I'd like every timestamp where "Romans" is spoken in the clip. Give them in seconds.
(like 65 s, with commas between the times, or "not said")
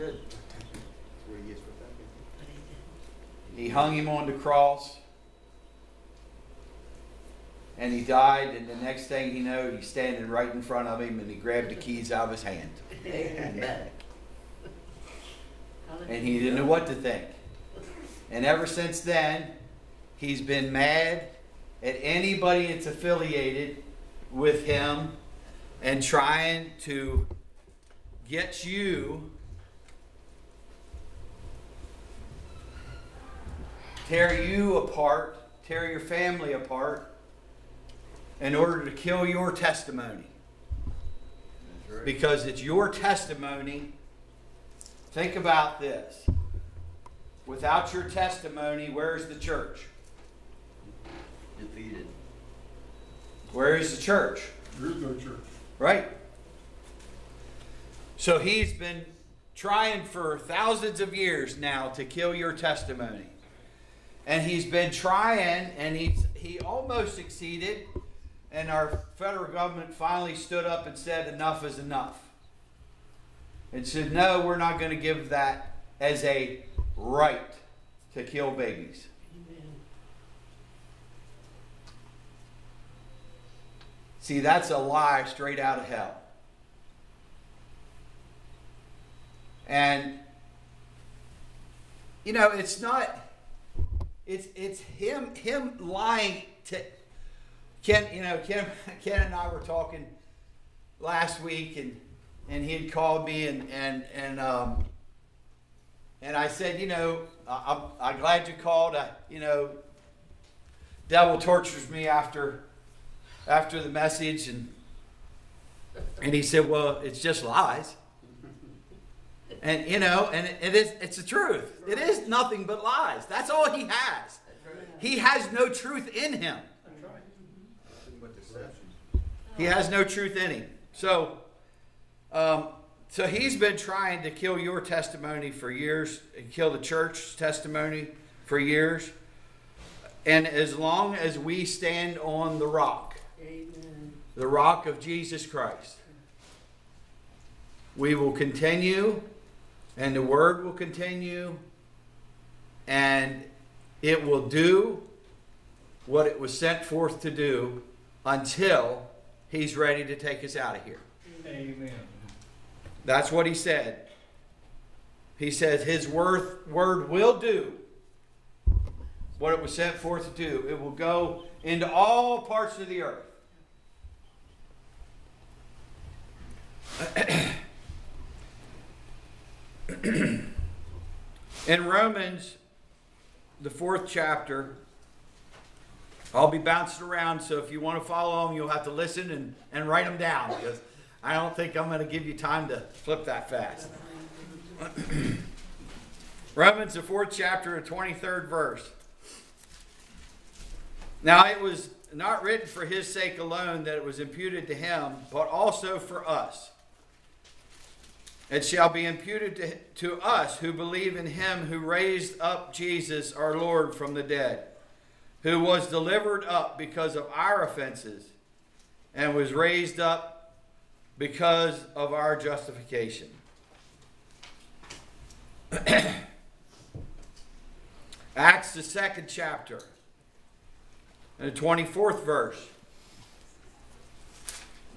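181 s, 196 s.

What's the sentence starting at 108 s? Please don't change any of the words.
I, you know, devil tortures me after after the message, and and he said, well, it's just lies.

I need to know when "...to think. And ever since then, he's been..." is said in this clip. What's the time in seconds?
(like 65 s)
16 s.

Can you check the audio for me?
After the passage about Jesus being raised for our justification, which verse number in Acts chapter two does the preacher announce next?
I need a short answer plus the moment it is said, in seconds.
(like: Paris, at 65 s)
24, at 231 s.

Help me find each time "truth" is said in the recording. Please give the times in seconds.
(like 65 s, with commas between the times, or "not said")
121 s, 125 s, 130 s.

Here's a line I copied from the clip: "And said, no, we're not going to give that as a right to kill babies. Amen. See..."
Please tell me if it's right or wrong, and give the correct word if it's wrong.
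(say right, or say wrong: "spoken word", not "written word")
right.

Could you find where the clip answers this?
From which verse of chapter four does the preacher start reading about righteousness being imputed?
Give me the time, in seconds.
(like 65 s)
197 s.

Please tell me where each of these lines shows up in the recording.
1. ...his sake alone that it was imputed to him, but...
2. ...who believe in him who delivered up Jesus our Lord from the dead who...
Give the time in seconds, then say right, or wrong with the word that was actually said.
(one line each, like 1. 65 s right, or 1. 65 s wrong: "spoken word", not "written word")
1. 202 s right
2. 210 s wrong: "raised", not "delivered".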